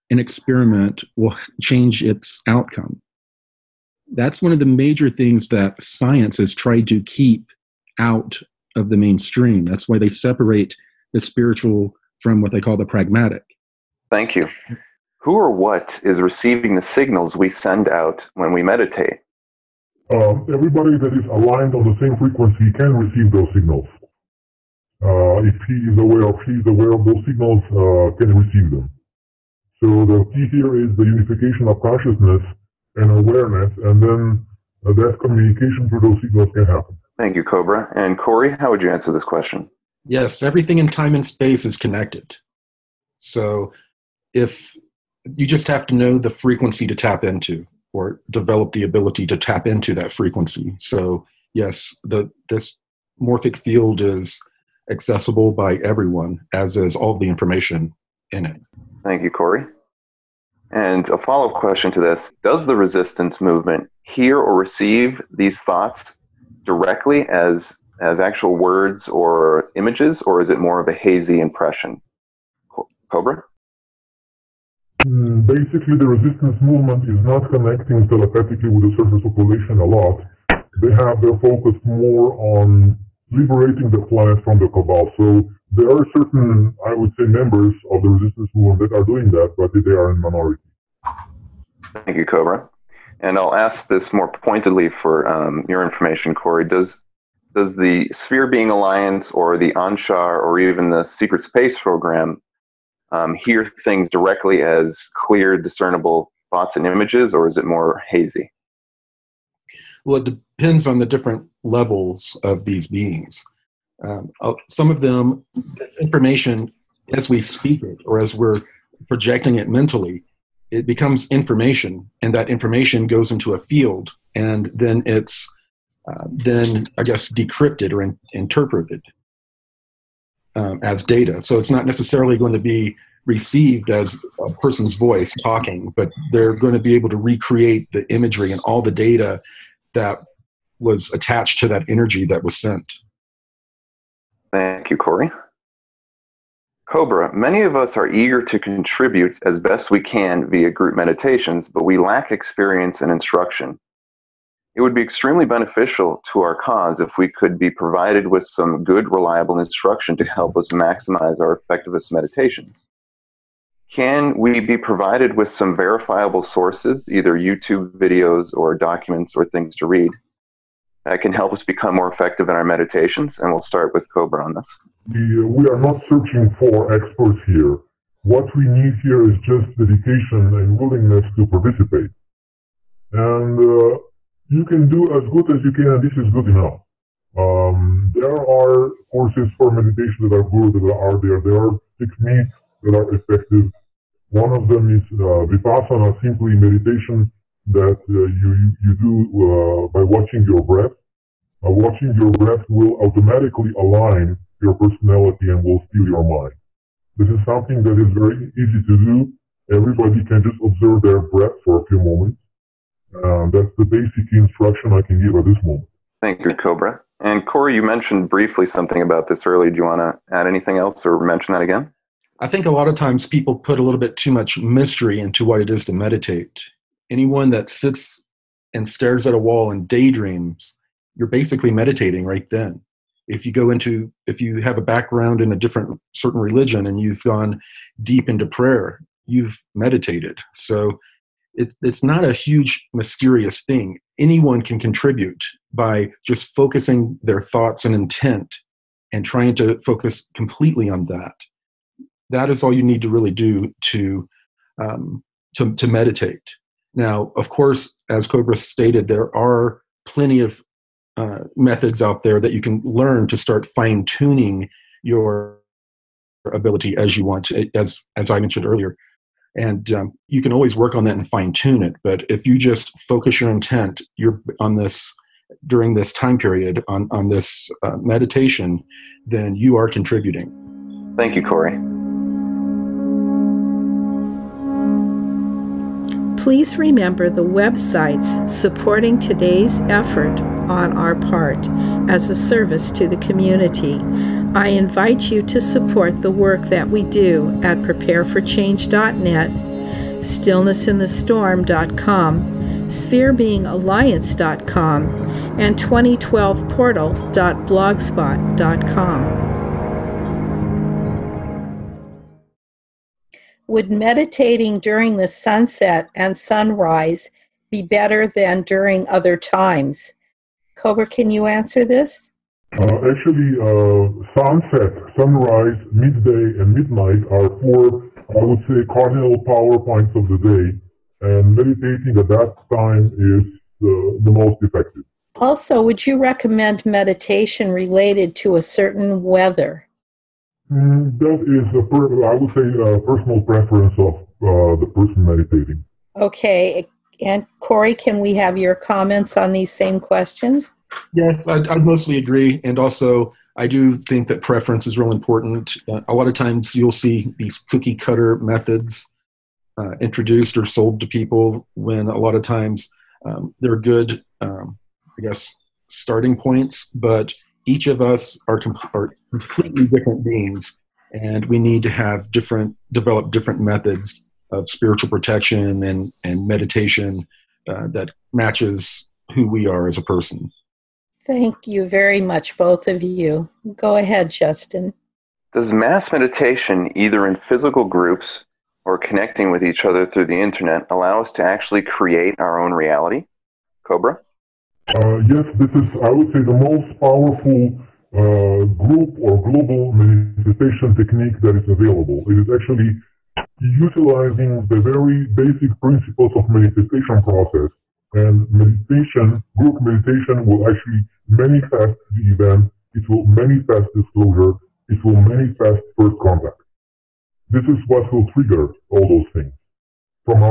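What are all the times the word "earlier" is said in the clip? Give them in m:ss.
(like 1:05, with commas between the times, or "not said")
3:39, 4:28.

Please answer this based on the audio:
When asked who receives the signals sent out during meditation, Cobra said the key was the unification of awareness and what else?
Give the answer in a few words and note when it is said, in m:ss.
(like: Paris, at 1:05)
consciousness, at 0:31.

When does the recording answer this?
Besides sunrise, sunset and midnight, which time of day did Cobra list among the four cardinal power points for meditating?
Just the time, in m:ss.
5:25.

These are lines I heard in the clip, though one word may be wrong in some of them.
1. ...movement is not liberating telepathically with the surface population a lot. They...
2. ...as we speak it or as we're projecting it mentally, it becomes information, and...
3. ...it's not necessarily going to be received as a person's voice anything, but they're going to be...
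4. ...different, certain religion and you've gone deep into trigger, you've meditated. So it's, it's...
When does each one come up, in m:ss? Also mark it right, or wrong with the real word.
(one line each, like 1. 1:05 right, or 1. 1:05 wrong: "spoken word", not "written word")
1. 1:16 wrong: "connecting", not "liberating"
2. 1:57 right
3. 2:11 wrong: "talking", not "anything"
4. 3:55 wrong: "prayer", not "trigger".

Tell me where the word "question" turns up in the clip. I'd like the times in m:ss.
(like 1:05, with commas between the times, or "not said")
0:39, 1:01, 5:49.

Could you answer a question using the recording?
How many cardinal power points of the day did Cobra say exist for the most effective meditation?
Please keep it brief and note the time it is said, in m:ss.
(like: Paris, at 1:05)
4, at 5:27.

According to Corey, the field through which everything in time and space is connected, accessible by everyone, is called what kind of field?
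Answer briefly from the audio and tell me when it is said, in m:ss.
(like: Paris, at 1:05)
morphic field, at 0:53.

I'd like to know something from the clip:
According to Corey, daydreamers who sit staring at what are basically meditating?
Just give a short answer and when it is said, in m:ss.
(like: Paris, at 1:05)
a wall, at 3:49.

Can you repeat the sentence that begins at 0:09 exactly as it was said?
That's why they separate the spiritual from what they call the pragmatic.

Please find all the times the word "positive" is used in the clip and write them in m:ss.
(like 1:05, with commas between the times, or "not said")
not said.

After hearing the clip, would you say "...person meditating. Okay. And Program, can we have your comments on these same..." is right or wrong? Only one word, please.
wrong.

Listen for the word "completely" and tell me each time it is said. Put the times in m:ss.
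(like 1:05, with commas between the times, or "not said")
4:10, 6:09.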